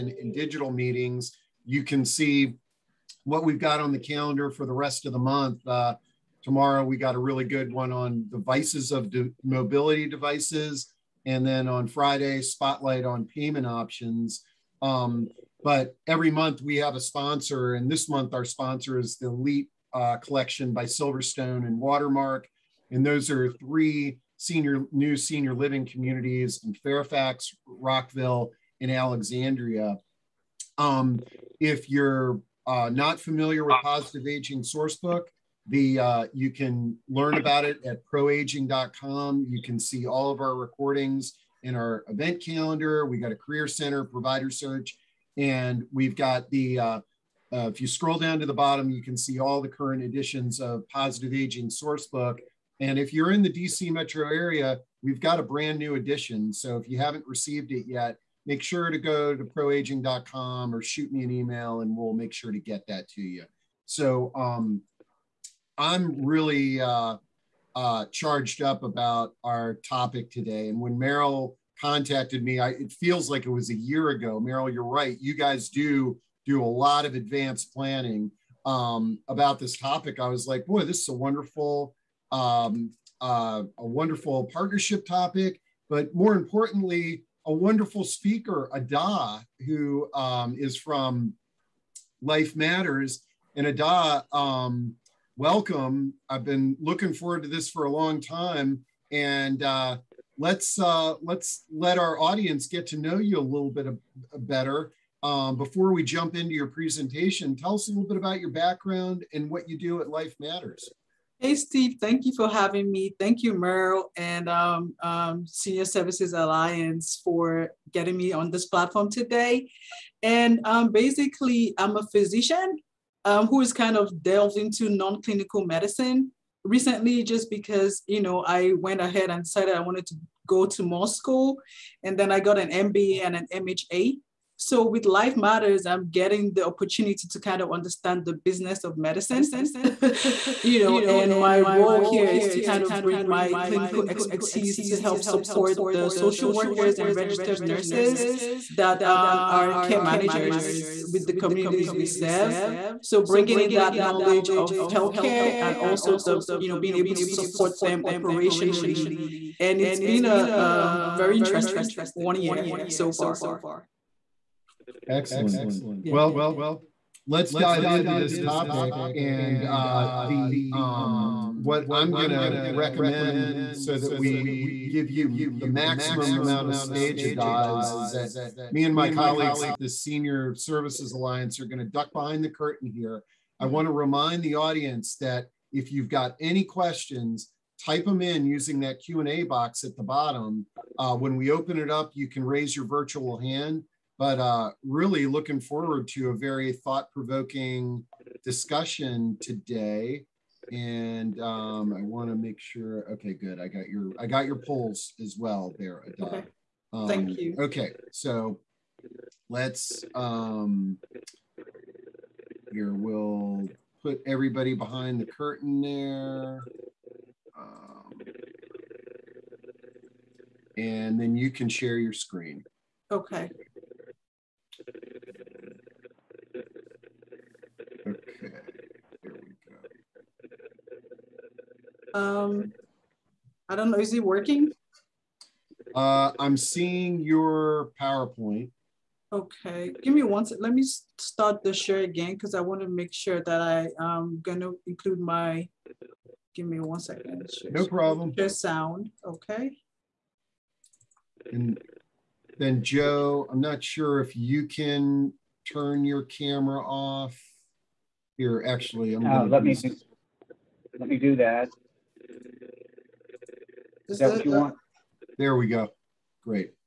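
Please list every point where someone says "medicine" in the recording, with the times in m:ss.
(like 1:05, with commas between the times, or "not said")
2:05, 2:18.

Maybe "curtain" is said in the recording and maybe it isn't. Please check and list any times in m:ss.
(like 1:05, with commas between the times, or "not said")
3:02, 3:35.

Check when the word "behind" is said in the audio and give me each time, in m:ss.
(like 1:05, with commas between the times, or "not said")
3:02, 3:34.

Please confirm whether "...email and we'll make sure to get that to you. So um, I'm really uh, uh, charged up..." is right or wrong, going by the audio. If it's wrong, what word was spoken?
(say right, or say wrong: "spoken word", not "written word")
right.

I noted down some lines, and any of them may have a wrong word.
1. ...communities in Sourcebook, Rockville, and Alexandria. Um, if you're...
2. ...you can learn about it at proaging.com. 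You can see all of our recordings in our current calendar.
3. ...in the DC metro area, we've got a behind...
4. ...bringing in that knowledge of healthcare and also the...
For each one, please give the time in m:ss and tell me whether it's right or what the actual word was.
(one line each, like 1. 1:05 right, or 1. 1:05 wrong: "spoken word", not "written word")
1. 0:25 wrong: "Fairfax", not "Sourcebook"
2. 0:36 wrong: "event", not "current"
3. 0:53 wrong: "brand", not "behind"
4. 2:33 right.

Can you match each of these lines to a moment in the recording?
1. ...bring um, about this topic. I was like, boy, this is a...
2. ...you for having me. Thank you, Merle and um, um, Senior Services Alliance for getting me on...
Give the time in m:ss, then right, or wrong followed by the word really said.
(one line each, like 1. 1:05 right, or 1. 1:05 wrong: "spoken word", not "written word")
1. 1:17 wrong: "planning", not "bring"
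2. 1:52 right.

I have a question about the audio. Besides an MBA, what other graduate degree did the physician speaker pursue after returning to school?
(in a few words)
MHA.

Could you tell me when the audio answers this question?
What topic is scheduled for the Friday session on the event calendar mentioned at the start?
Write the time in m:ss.
0:12.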